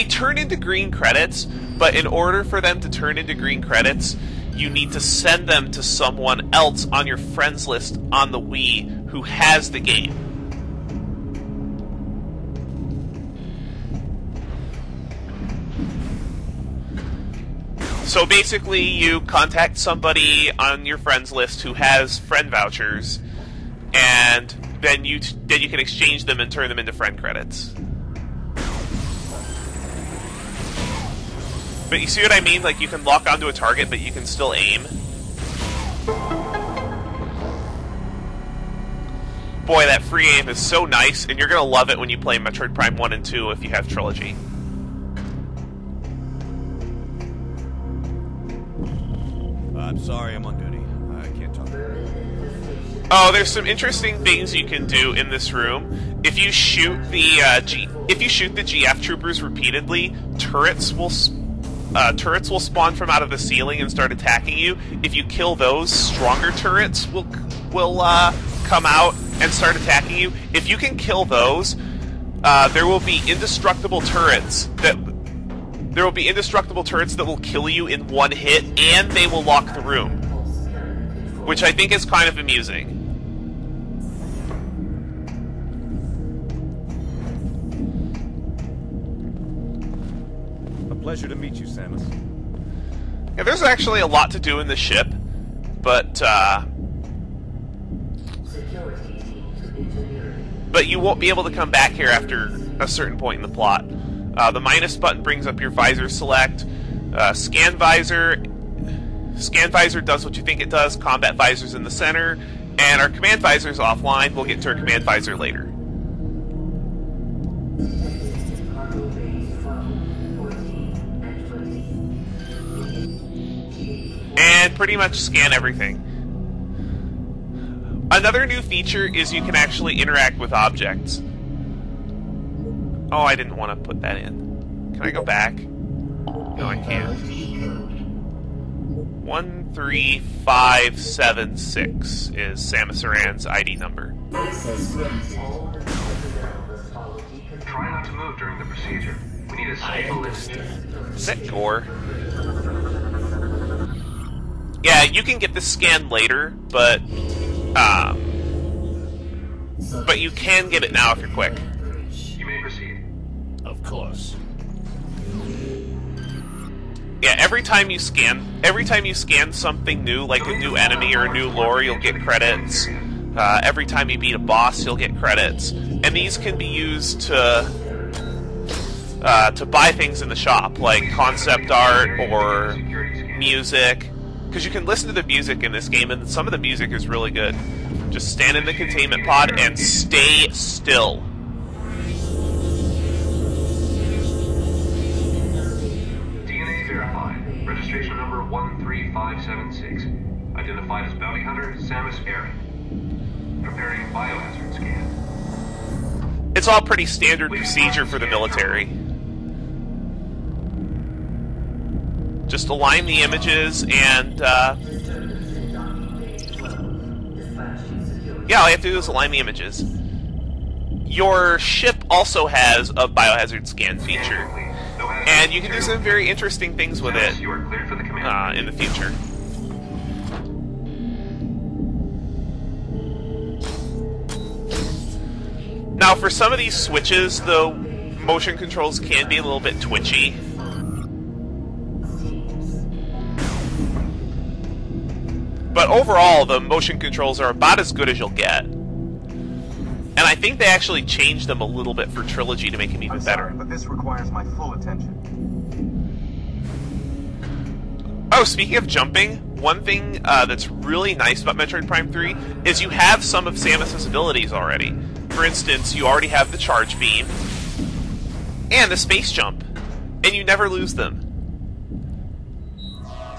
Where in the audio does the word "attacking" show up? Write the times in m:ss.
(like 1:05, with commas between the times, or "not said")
1:04, 1:09.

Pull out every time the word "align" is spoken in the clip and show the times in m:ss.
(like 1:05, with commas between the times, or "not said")
3:32, 3:39.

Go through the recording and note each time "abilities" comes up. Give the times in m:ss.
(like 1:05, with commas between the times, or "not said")
4:24.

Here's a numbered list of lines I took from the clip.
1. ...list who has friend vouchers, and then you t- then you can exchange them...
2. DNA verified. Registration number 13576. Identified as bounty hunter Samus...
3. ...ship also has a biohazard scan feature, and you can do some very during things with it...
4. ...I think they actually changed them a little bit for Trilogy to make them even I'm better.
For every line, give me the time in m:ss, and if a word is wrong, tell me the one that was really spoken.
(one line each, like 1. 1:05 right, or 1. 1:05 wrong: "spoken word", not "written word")
1. 0:21 right
2. 3:16 right
3. 3:41 wrong: "interesting", not "during"
4. 4:10 right.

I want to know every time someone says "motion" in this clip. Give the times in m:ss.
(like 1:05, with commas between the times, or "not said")
3:58, 4:06.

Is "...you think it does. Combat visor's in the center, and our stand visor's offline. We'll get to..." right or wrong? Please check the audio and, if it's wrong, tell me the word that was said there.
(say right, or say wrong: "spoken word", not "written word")
wrong: "command", not "stand".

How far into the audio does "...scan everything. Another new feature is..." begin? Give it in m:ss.
2:05.